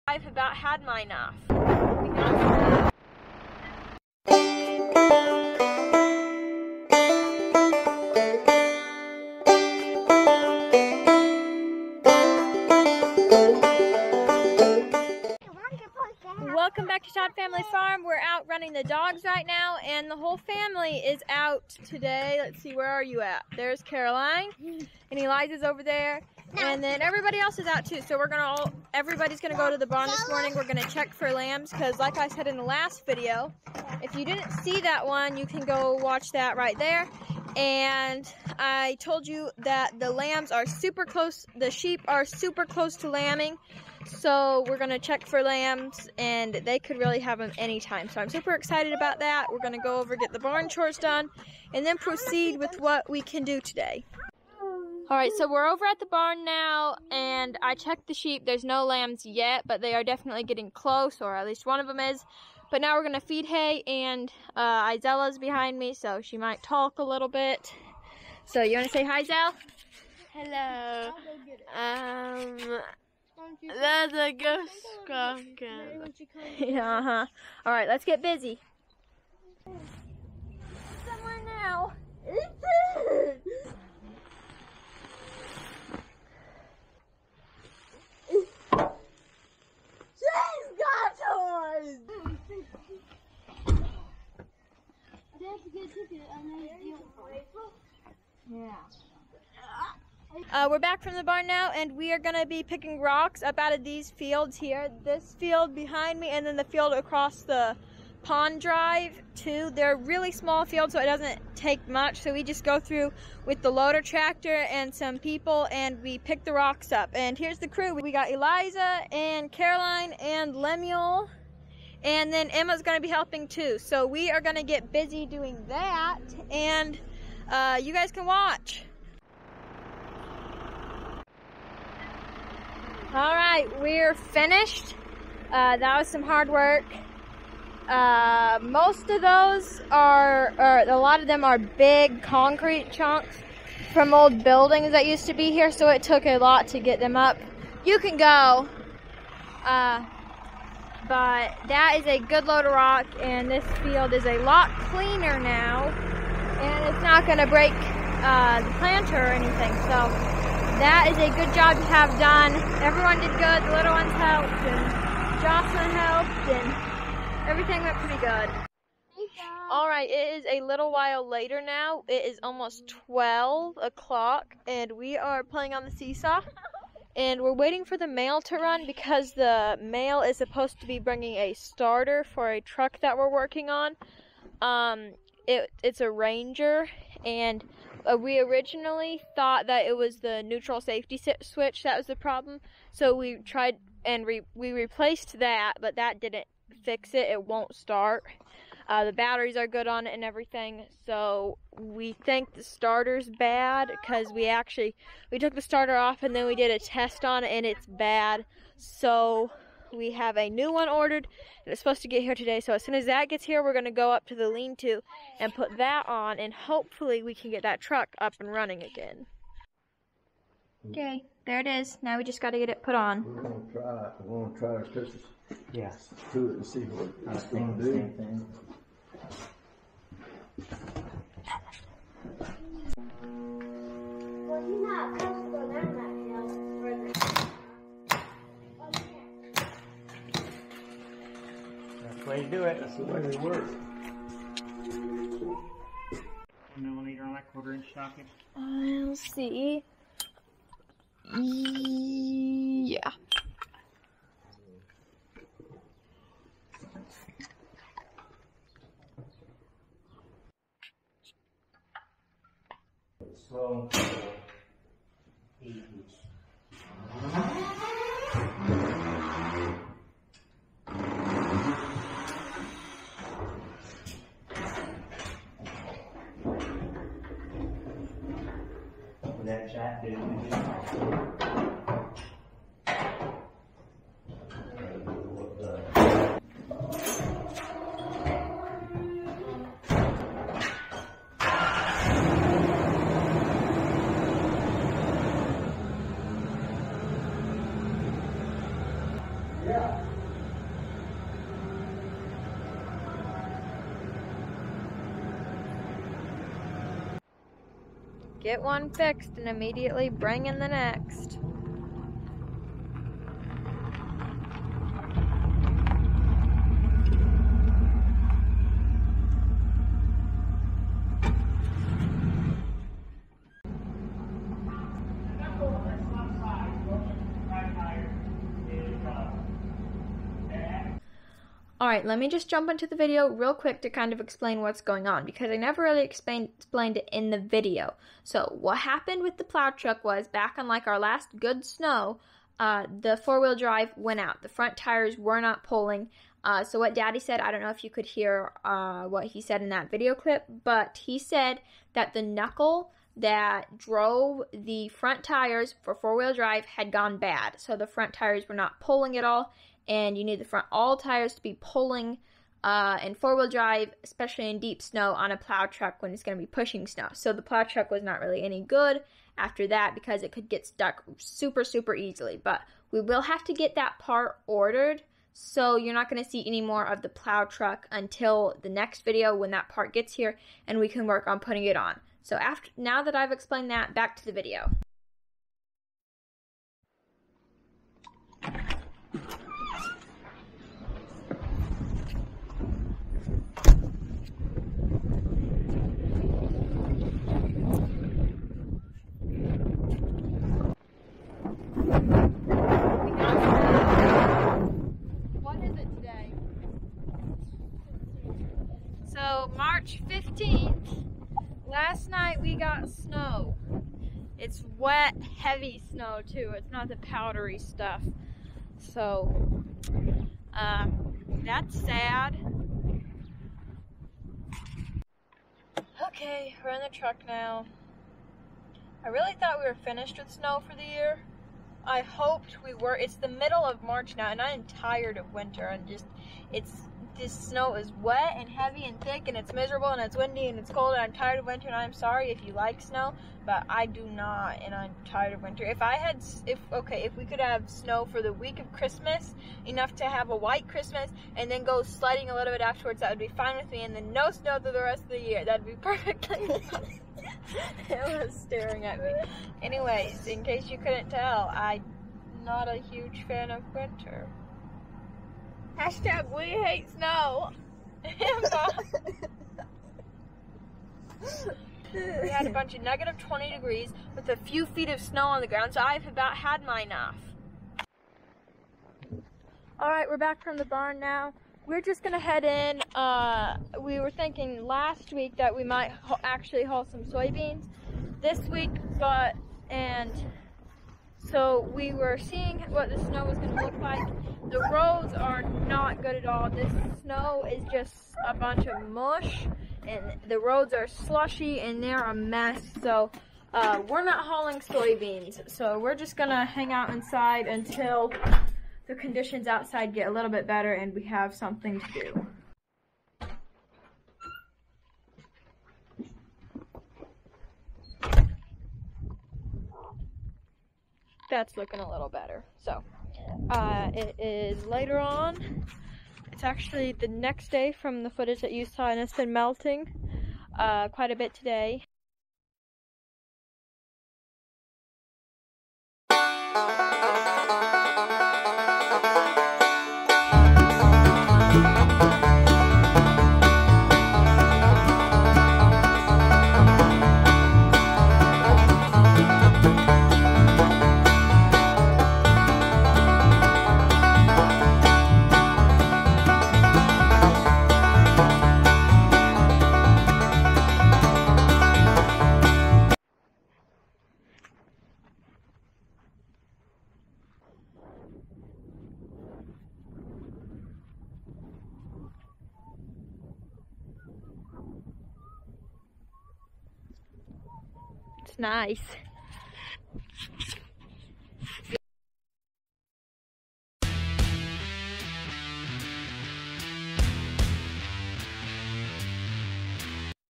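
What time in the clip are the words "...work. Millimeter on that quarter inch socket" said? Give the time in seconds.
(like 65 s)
243 s.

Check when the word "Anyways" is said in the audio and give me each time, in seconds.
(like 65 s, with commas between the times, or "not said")
459 s.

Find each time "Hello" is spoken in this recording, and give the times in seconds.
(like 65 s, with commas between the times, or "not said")
70 s.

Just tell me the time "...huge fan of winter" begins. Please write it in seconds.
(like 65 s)
462 s.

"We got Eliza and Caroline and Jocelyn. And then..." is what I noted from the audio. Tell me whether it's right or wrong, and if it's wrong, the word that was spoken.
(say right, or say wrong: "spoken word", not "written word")
wrong: "Lemuel", not "Jocelyn".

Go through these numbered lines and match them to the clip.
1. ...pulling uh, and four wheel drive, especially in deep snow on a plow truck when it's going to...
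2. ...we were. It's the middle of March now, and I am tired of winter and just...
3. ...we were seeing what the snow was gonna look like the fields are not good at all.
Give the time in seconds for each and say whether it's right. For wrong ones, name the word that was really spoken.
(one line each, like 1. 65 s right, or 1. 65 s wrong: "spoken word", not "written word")
1. 361 s right
2. 432 s right
3. 491 s wrong: "roads", not "fields".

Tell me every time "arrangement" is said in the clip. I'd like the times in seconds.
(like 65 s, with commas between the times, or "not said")
not said.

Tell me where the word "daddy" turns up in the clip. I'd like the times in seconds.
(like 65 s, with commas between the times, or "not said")
346 s.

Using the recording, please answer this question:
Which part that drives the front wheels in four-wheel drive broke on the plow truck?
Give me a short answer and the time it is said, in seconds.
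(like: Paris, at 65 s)
The knuckle, at 352 s.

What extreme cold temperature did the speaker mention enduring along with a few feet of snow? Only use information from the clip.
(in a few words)
Negative 20 degrees.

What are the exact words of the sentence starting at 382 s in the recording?
So after now that I've explained that, back to the video.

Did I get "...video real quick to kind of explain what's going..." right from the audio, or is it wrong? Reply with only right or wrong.
right.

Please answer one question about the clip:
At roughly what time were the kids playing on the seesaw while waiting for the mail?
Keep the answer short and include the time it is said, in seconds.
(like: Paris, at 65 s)
12 o'clock, at 173 s.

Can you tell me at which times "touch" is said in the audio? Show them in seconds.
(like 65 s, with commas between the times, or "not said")
224 s.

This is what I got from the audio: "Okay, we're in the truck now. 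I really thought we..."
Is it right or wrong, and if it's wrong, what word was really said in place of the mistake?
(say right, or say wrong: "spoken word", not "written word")
right.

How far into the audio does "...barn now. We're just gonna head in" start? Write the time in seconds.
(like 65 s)
480 s.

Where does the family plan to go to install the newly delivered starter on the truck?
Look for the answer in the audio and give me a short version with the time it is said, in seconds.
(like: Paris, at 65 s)
The lean-to, at 214 s.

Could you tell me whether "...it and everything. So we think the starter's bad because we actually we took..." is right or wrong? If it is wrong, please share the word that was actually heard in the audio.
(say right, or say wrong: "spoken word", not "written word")
right.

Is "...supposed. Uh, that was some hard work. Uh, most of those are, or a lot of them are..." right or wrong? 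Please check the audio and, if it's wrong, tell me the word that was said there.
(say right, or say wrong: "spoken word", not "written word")
wrong: "finished", not "supposed".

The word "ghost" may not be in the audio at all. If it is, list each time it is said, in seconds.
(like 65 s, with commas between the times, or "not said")
74 s.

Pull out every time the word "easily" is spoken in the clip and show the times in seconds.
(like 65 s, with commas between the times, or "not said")
371 s.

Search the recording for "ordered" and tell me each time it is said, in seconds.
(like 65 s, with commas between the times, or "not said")
210 s, 374 s.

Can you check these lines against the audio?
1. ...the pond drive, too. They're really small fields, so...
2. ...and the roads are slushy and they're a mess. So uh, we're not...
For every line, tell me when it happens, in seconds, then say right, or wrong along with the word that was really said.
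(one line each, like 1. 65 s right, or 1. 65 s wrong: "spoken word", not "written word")
1. 107 s right
2. 499 s right.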